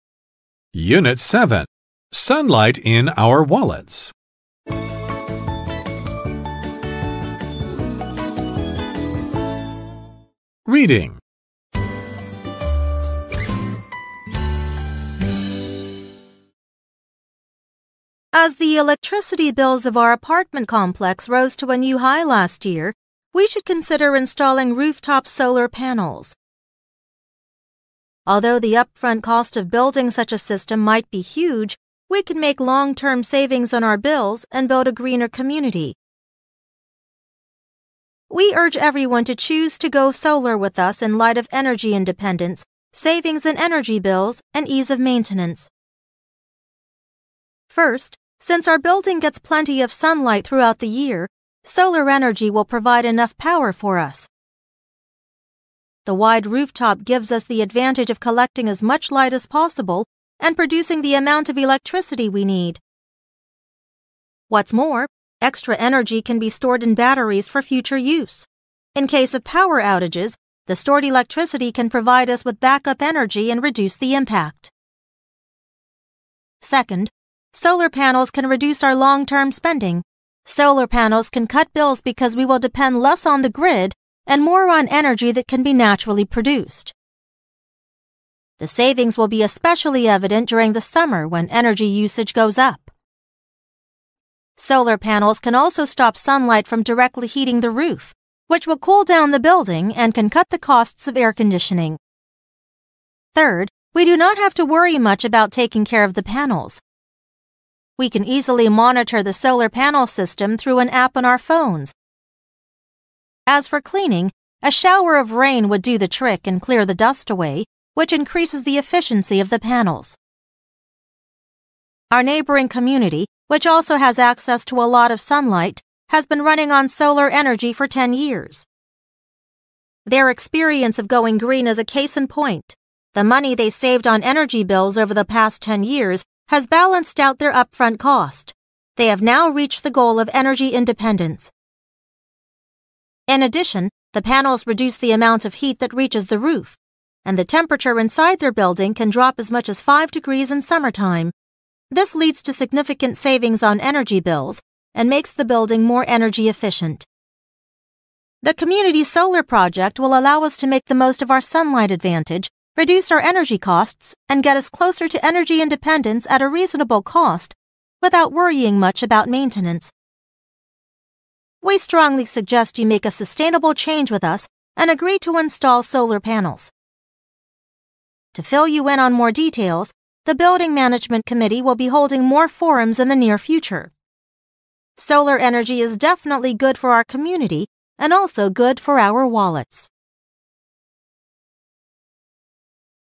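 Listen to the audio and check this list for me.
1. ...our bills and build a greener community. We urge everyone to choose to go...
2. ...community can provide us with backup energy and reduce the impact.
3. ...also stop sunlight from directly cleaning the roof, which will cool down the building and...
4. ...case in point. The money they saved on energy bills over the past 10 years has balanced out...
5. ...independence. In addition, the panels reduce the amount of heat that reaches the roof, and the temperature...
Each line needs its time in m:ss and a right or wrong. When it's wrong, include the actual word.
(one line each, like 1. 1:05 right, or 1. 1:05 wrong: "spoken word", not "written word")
1. 0:33 right
2. 1:11 wrong: "electricity", not "community"
3. 1:35 wrong: "heating", not "cleaning"
4. 2:11 right
5. 2:20 right.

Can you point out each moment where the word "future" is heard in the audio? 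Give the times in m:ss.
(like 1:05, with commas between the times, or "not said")
1:07, 3:03.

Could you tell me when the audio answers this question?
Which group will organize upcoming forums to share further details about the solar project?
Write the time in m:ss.
3:00.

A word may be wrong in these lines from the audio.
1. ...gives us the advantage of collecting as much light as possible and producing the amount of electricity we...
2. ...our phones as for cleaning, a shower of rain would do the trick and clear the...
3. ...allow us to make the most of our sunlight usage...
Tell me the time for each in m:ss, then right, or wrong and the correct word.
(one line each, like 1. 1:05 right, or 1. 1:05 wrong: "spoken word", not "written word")
1. 0:57 right
2. 1:51 right
3. 2:40 wrong: "advantage", not "usage".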